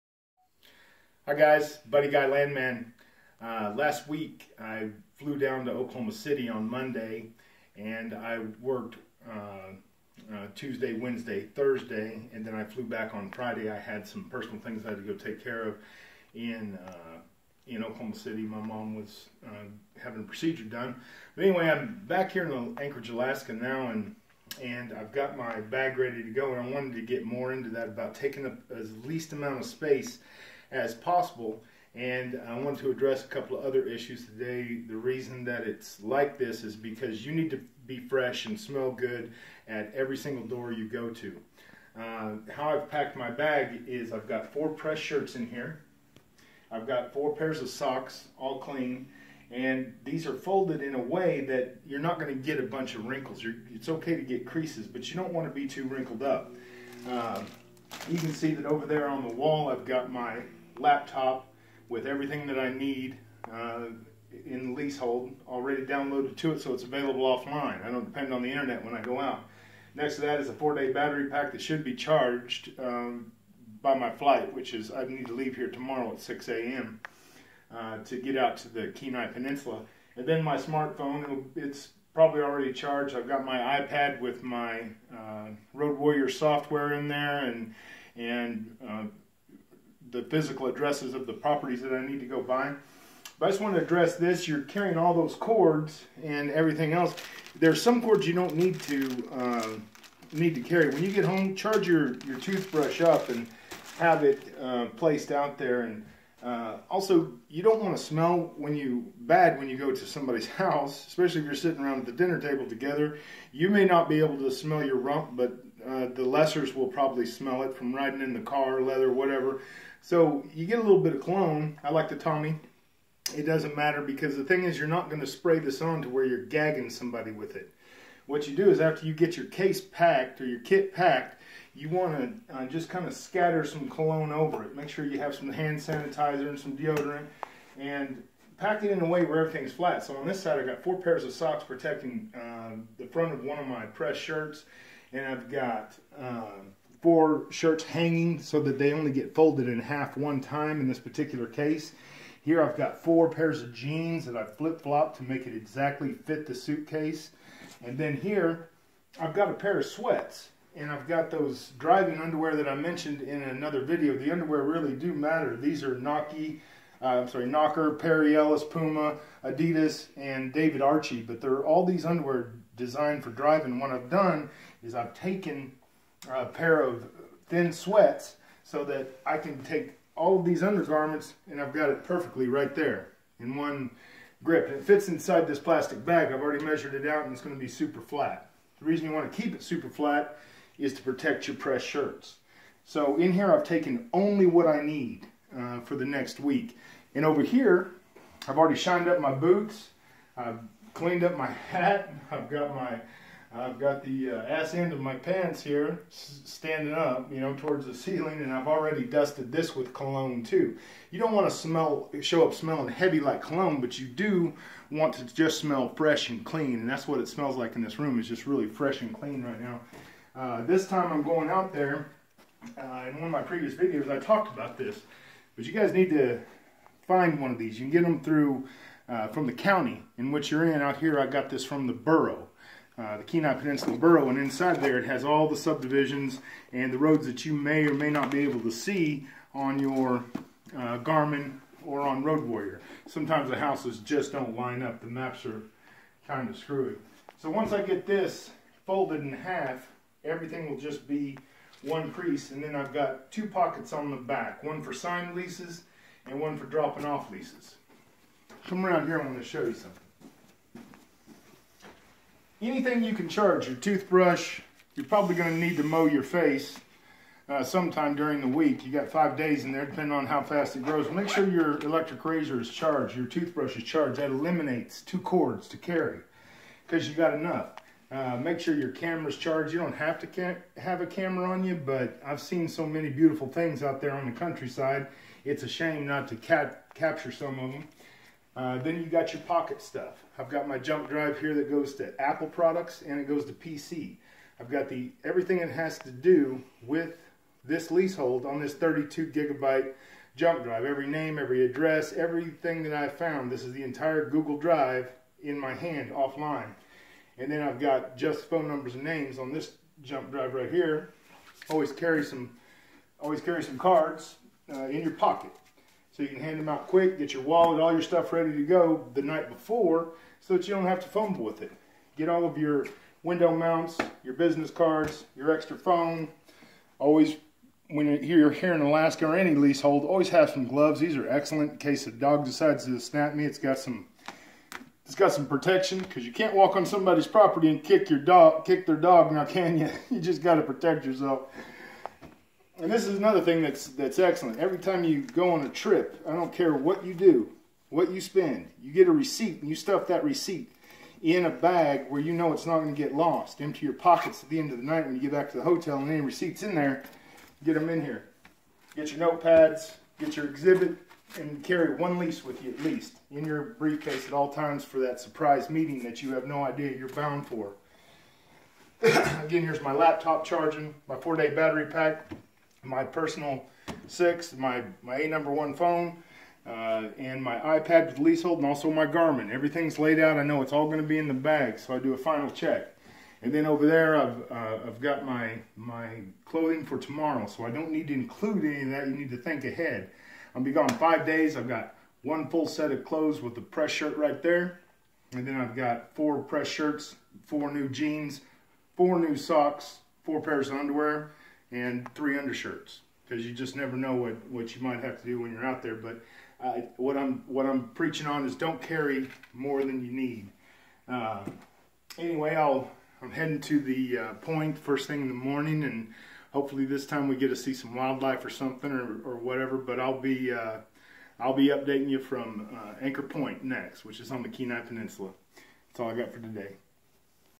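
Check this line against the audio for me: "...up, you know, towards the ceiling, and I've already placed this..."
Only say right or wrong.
wrong.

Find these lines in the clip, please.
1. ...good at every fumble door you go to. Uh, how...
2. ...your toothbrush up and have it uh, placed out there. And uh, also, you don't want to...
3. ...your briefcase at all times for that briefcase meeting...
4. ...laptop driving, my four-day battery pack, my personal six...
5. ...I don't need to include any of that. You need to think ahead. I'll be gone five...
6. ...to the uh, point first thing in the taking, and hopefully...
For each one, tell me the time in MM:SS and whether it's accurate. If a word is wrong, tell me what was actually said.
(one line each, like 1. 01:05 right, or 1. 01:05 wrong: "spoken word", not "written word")
1. 00:38 wrong: "single", not "fumble"
2. 01:42 right
3. 06:03 wrong: "surprise", not "briefcase"
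4. 06:09 wrong: "charging", not "driving"
5. 06:27 right
6. 06:53 wrong: "morning", not "taking".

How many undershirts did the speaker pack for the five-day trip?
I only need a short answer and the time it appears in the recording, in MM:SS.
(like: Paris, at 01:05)
3, at 06:42.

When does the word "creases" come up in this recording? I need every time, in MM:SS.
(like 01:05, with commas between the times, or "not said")
00:54, 04:12.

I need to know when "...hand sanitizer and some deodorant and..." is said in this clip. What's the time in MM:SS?
02:15.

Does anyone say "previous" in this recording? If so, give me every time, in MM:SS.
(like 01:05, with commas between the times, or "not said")
03:43.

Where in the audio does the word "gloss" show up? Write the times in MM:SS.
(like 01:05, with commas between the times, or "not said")
not said.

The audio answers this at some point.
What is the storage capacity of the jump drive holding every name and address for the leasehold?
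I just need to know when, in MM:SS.
04:58.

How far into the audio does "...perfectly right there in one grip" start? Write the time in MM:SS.
03:02.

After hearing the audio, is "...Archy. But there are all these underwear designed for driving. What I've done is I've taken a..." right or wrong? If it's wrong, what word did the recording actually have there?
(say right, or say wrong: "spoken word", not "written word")
right.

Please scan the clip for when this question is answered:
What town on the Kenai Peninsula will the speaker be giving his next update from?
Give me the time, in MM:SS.
07:03.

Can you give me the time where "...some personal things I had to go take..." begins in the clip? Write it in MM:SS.
00:14.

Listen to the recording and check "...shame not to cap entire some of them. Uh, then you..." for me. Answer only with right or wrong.
wrong.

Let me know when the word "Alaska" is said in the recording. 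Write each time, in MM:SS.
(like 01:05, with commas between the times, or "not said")
00:23, 05:28.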